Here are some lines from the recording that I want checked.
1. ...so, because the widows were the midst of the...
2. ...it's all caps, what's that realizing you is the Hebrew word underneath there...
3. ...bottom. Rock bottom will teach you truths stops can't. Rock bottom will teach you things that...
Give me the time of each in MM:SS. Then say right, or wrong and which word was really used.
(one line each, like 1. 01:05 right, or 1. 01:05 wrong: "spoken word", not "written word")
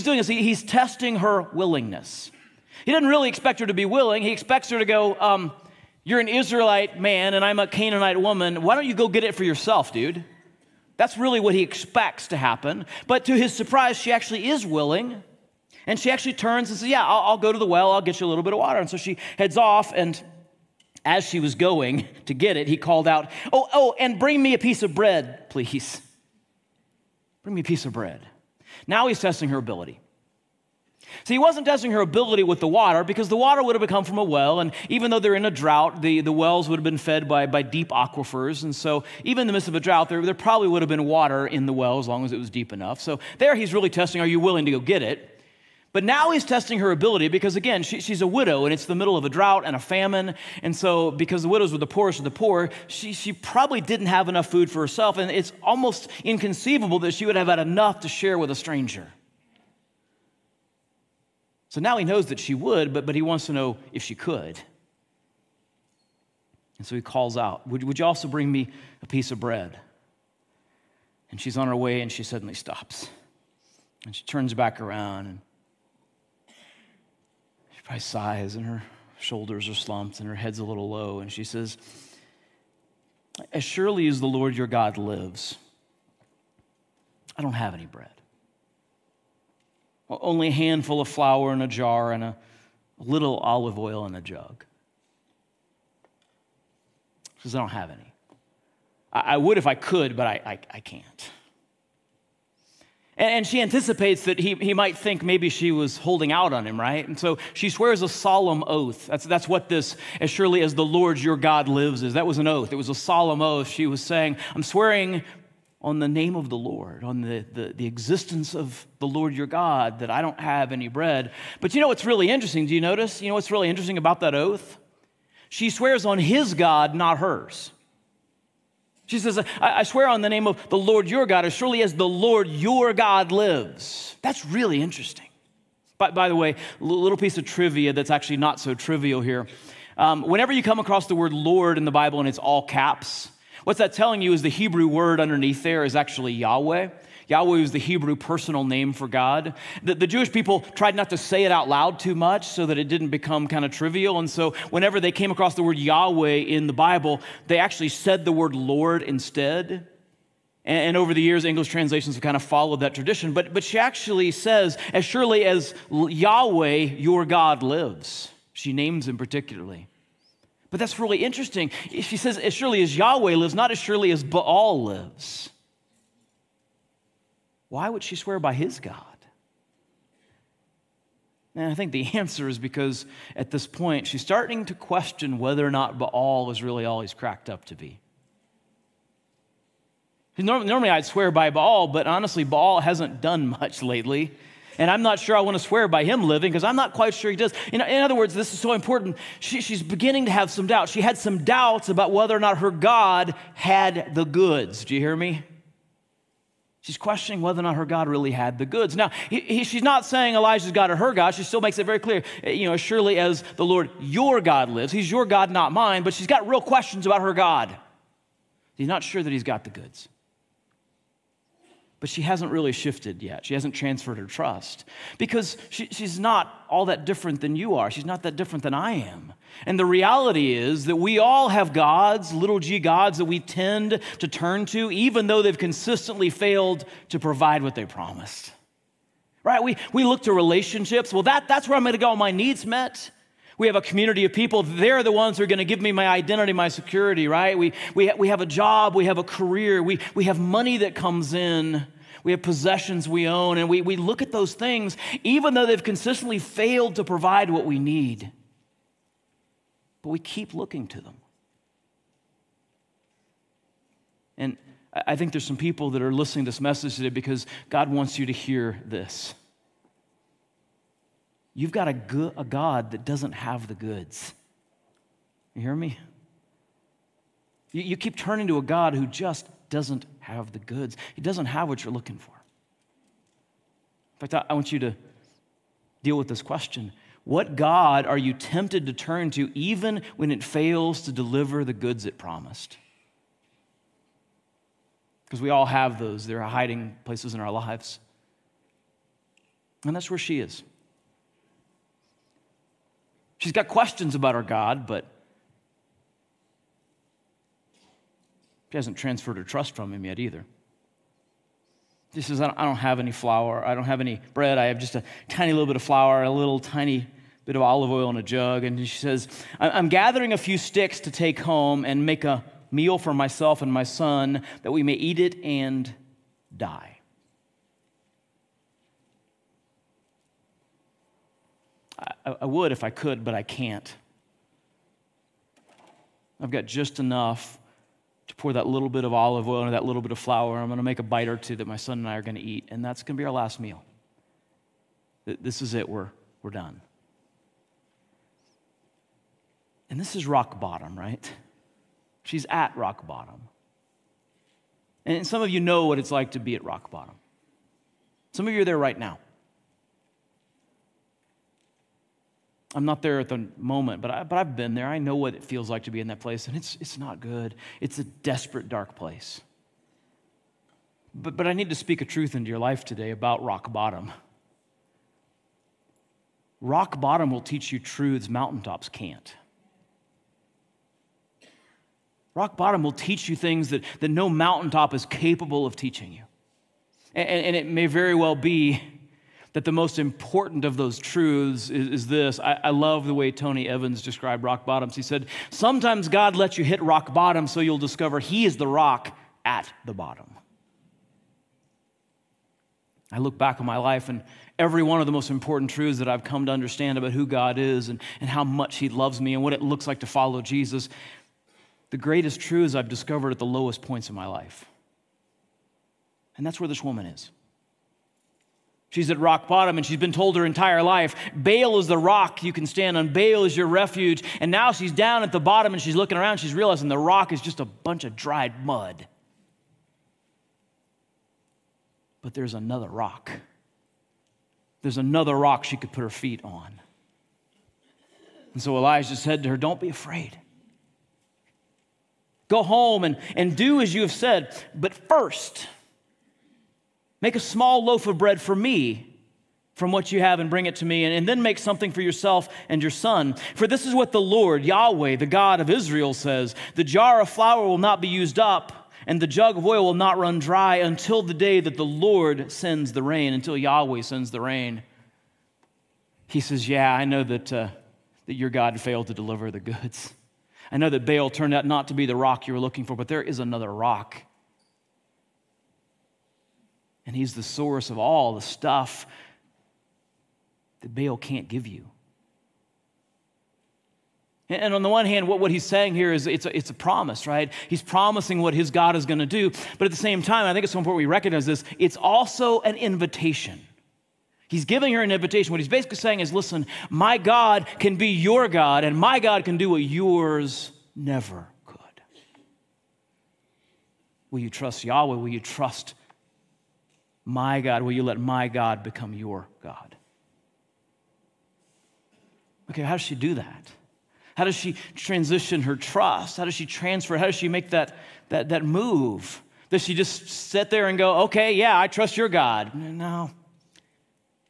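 1. 00:50 wrong: "poorest", not "midst"
2. 02:22 wrong: "telling", not "realizing"
3. 06:13 wrong: "mountaintops", not "stops".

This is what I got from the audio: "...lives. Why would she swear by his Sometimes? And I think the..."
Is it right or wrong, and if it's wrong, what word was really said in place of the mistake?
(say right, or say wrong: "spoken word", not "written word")
wrong: "God", not "Sometimes".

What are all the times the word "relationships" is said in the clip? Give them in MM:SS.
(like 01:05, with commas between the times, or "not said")
04:00.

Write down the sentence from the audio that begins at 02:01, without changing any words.
But you know what's really interesting?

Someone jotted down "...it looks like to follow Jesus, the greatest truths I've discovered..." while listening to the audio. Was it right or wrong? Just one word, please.
right.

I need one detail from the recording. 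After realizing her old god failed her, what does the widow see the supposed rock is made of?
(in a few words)
dried mud.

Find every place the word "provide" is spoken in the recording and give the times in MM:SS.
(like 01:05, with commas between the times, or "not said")
03:57, 04:17.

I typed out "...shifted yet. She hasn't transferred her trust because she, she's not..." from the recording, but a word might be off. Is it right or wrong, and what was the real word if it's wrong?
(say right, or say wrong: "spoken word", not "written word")
right.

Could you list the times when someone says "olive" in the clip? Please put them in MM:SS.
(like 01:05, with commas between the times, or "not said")
01:33, 05:17, 05:39.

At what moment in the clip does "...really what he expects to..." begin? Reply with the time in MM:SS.
00:11.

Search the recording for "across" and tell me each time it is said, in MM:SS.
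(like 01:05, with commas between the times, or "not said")
02:20, 02:35.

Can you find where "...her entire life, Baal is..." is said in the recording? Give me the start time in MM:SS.
07:00.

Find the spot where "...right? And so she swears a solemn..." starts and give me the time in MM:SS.
01:46.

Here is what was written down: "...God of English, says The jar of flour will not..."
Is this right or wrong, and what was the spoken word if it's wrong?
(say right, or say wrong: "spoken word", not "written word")
wrong: "Israel", not "English".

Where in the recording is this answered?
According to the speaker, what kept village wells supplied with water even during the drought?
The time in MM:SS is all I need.
00:37.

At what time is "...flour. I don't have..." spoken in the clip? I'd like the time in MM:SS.
05:13.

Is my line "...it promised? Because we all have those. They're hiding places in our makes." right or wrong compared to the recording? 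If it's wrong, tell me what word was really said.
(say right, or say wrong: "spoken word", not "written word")
wrong: "lives", not "makes".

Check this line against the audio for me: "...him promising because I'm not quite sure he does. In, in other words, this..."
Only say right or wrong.
wrong.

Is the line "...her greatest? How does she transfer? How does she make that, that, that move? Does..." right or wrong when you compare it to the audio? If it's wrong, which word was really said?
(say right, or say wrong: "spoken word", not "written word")
wrong: "trust", not "greatest".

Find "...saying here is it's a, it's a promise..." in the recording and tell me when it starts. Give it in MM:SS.
08:05.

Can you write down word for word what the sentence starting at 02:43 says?
But, but she actually says, as surely as Yahweh, your God, lives, she names him particularly.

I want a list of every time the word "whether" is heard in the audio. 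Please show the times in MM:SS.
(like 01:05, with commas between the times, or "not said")
03:05, 03:22, 03:27.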